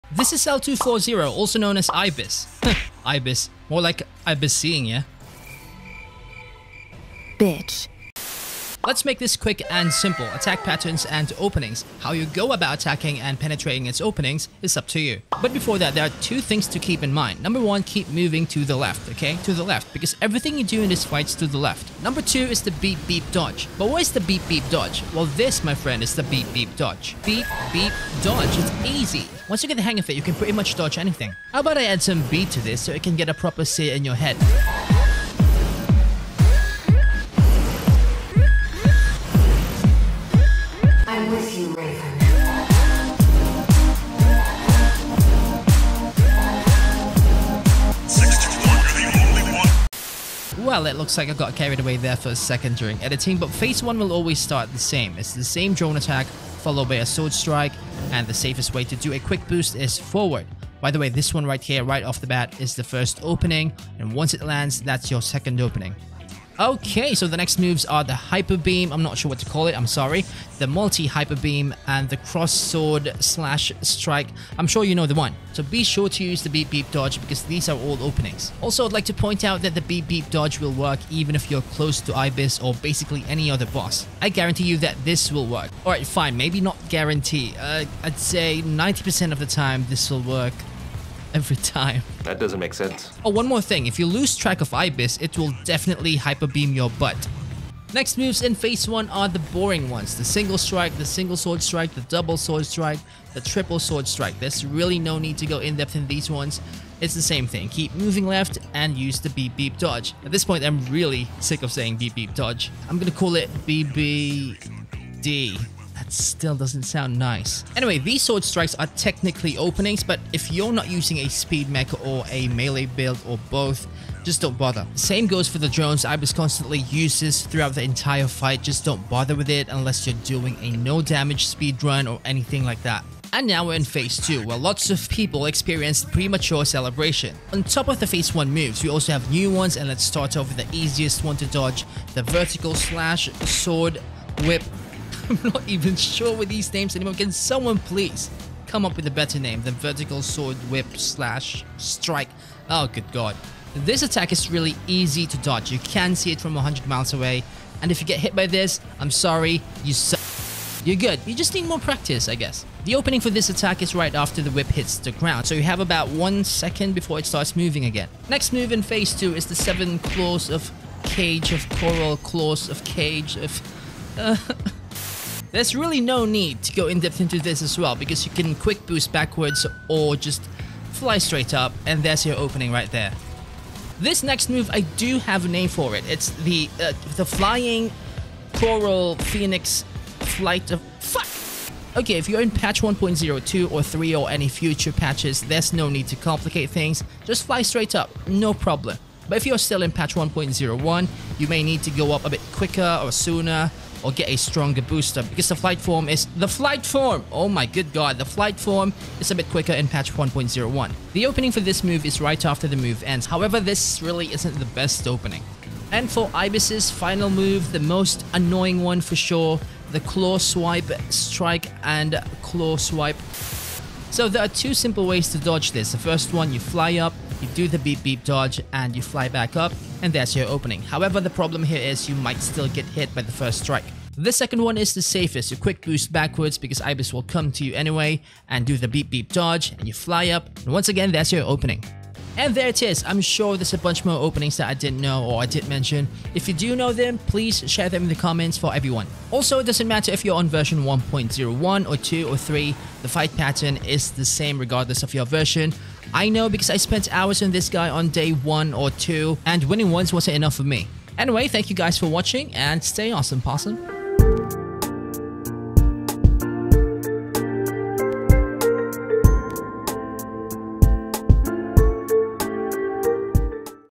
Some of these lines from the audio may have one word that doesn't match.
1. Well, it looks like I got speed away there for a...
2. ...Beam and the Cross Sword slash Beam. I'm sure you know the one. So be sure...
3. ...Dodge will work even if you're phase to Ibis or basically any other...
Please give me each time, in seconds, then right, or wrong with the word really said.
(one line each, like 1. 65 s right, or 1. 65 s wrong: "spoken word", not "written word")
1. 50 s wrong: "carried", not "speed"
2. 71 s wrong: "Strike", not "Beam"
3. 80 s wrong: "close", not "phase".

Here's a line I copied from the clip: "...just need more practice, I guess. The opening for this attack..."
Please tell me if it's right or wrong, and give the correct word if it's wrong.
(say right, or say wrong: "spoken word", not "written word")
right.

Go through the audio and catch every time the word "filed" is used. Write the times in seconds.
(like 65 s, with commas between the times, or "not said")
not said.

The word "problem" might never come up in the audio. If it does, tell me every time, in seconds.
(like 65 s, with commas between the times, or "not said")
198 s, 231 s.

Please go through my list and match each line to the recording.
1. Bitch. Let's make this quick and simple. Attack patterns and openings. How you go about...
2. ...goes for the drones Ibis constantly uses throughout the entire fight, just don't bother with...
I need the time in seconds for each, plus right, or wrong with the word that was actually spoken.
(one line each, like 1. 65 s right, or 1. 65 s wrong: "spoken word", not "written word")
1. 7 s right
2. 125 s right.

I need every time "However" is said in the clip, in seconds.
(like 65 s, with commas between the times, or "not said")
213 s, 230 s.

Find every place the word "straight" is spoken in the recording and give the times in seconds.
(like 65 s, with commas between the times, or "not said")
181 s, 197 s.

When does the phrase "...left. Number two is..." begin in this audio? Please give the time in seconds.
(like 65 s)
21 s.